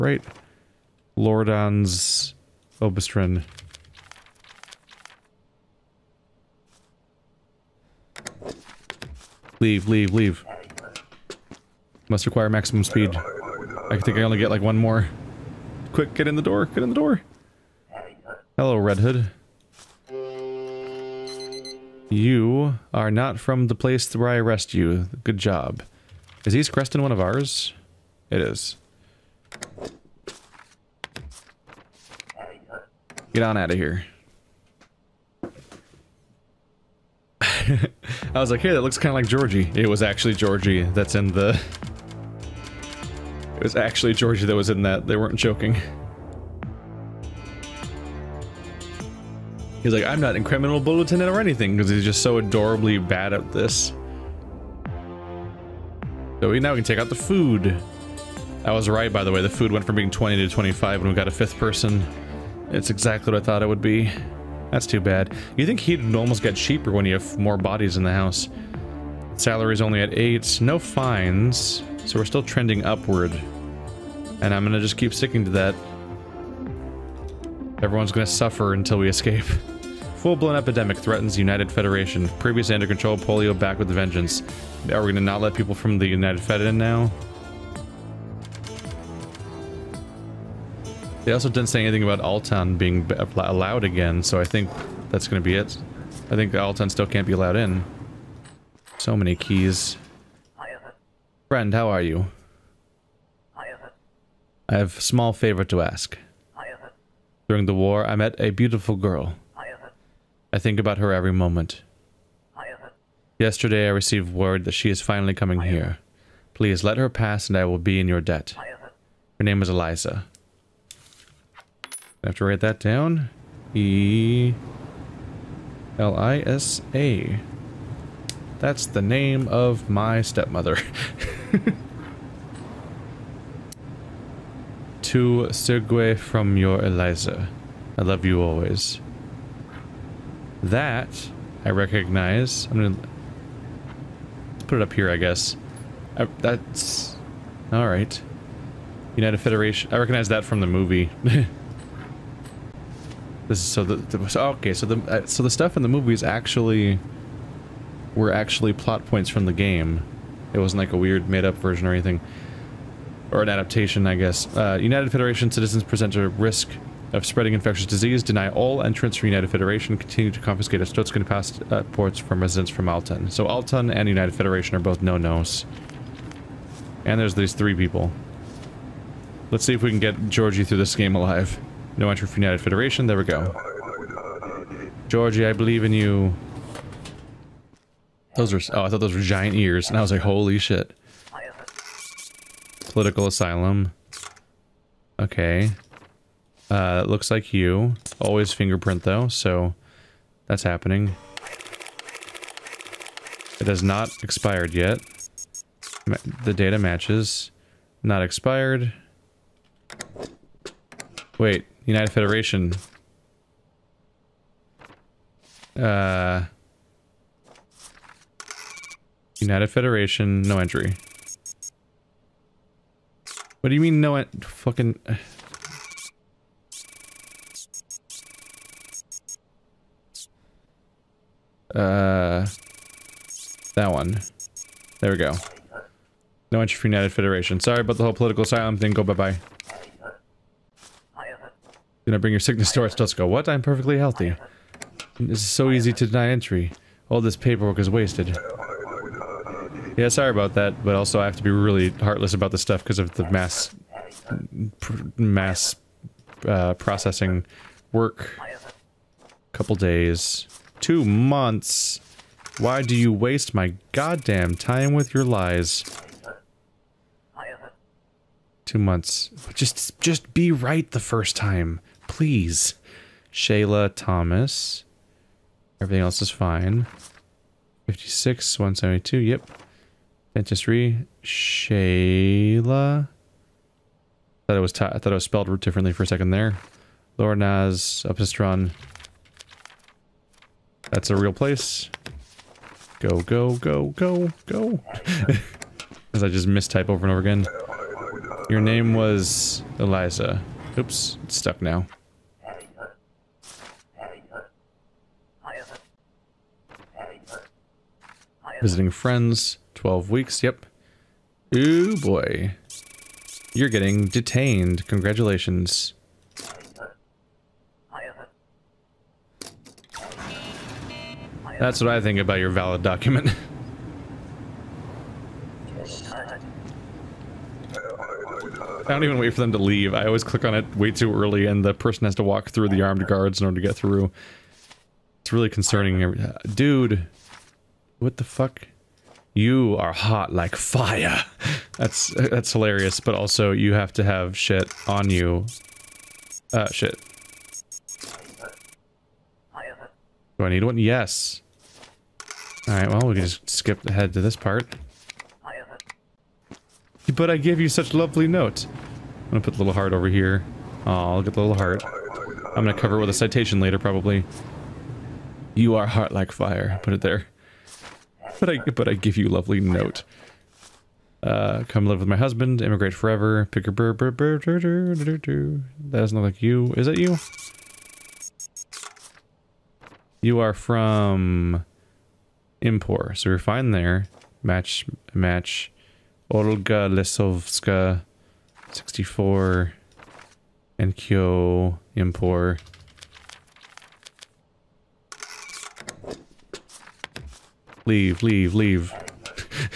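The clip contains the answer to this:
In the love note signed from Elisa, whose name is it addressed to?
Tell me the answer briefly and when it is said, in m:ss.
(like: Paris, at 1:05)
Sergiu, at 2:15.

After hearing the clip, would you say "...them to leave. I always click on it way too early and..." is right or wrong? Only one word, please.
right.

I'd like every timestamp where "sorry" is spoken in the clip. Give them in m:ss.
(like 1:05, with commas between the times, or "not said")
3:57, 4:10.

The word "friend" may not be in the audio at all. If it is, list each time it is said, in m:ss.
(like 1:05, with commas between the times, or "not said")
1:41, 5:08.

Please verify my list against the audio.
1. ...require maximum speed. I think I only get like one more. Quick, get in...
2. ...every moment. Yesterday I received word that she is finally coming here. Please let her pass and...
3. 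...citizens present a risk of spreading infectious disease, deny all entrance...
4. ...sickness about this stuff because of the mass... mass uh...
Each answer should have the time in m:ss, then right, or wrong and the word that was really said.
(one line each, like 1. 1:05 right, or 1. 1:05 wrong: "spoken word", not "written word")
1. 0:12 right
2. 1:51 right
3. 2:45 right
4. 4:11 wrong: "heartless", not "sickness".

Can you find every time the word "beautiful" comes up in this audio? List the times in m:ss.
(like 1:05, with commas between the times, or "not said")
1:48.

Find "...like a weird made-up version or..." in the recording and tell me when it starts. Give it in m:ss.
2:40.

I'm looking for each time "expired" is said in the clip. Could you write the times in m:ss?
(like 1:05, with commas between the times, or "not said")
3:24, 3:28.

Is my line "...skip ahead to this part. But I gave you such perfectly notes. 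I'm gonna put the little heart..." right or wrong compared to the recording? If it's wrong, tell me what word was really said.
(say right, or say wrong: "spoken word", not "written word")
wrong: "lovely", not "perfectly".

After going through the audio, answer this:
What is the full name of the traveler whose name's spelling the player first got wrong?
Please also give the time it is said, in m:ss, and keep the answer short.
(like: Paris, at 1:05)
Shayla Thomas, at 4:33.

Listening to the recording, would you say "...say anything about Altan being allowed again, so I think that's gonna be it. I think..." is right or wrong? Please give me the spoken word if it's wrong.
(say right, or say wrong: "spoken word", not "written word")
right.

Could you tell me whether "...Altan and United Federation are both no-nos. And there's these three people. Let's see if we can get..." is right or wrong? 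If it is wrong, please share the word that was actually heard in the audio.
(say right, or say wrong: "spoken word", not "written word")
right.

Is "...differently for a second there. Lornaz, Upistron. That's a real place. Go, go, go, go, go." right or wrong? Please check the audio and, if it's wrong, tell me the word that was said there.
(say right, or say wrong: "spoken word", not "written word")
right.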